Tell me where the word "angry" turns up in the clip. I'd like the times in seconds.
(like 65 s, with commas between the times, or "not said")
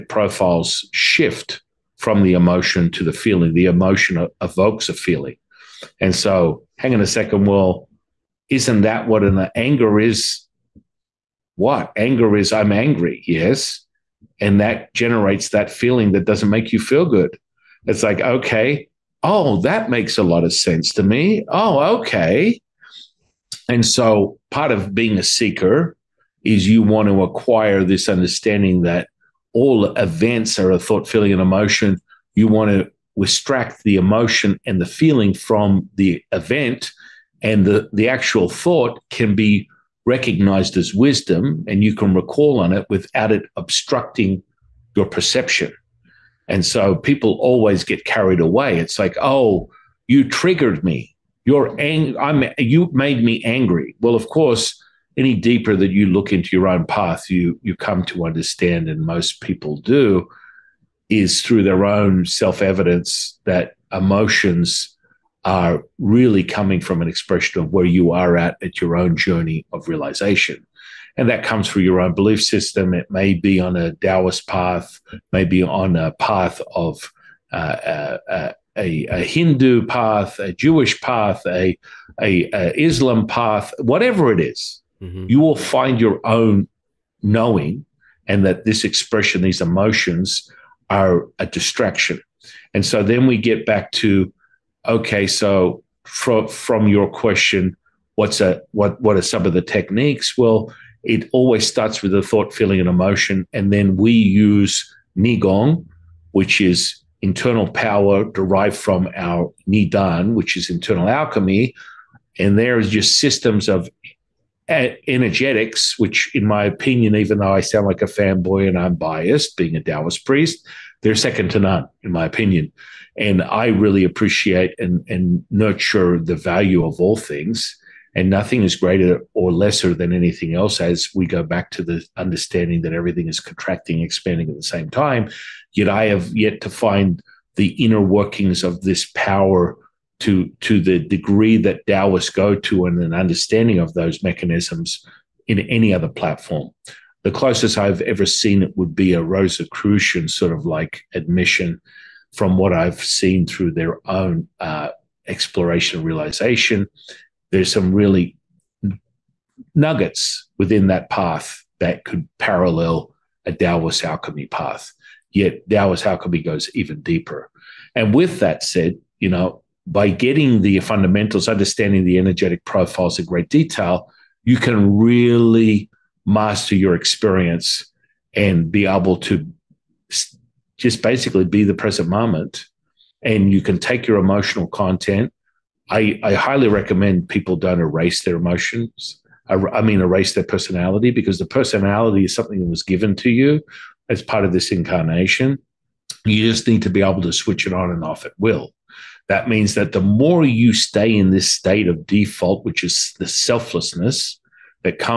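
12 s, 53 s.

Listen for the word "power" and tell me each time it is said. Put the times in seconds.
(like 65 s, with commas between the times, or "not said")
107 s, 139 s.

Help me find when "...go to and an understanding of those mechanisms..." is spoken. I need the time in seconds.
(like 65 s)
142 s.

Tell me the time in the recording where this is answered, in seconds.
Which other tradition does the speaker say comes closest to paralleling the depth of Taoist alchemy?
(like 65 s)
149 s.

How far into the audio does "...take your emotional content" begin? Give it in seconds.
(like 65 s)
183 s.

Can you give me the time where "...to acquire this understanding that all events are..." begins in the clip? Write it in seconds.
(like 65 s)
27 s.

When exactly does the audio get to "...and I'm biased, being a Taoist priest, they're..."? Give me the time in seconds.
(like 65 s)
118 s.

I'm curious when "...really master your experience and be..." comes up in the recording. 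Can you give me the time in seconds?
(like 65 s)
174 s.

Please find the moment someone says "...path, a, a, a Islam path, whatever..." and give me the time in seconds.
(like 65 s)
81 s.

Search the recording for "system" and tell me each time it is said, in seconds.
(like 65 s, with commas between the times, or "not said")
72 s, 113 s.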